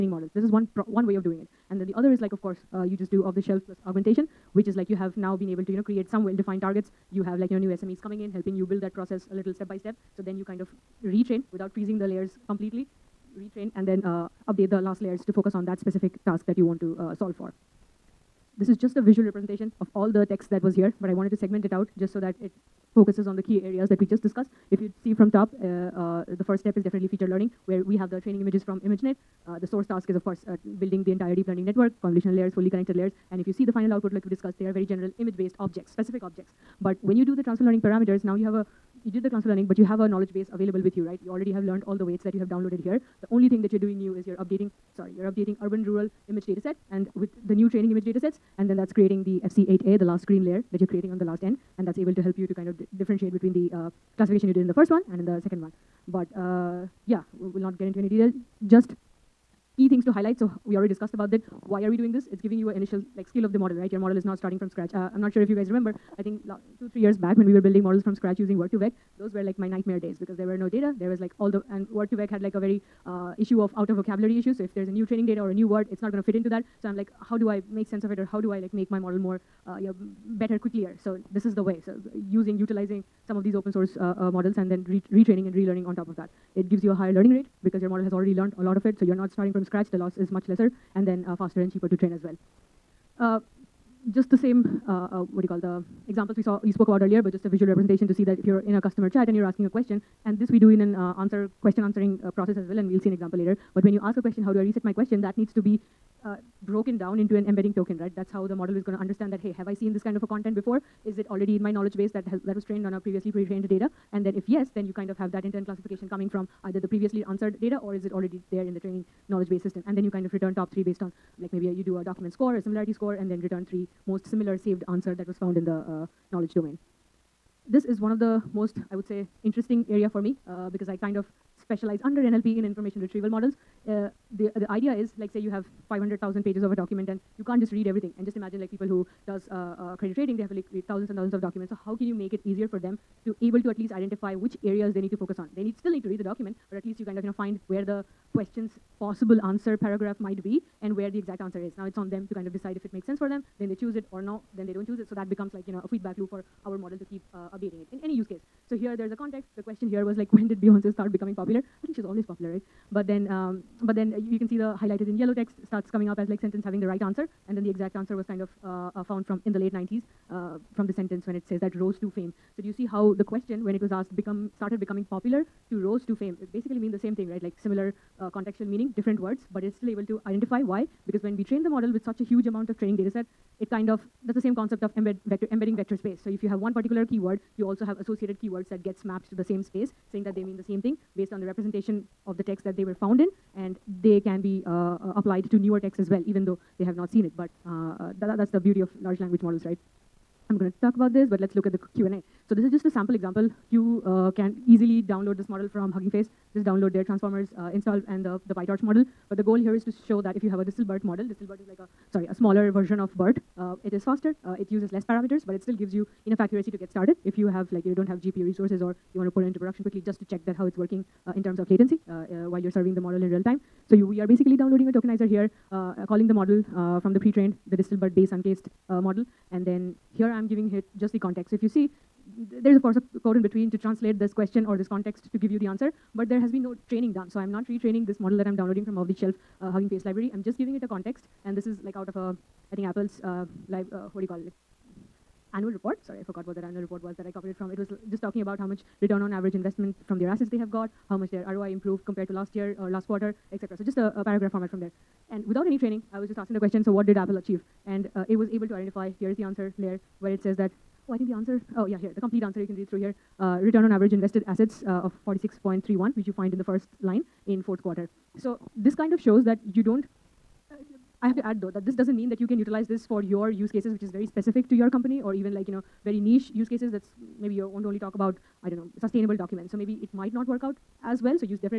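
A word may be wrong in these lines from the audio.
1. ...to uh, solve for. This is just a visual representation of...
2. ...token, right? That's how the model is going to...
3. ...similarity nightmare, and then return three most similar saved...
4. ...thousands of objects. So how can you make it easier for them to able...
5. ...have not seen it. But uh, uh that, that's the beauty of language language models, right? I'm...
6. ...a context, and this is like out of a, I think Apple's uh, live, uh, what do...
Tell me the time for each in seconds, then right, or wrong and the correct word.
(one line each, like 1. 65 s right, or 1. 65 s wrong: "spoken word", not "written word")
1. 16 s right
2. 107 s right
3. 122 s wrong: "score", not "nightmare"
4. 141 s wrong: "documents", not "objects"
5. 196 s wrong: "large", not "language"
6. 240 s right.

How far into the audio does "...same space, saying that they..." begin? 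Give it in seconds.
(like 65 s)
189 s.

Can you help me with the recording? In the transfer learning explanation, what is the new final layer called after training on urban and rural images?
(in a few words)
FC8A.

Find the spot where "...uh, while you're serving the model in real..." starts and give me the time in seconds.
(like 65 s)
222 s.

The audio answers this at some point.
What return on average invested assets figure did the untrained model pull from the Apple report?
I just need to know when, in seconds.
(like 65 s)
265 s.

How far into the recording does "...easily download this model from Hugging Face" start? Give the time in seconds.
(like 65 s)
204 s.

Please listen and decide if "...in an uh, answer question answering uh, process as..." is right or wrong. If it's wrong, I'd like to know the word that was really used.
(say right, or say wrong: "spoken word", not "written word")
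right.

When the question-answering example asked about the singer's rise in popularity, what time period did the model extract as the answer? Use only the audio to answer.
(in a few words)
late 90s.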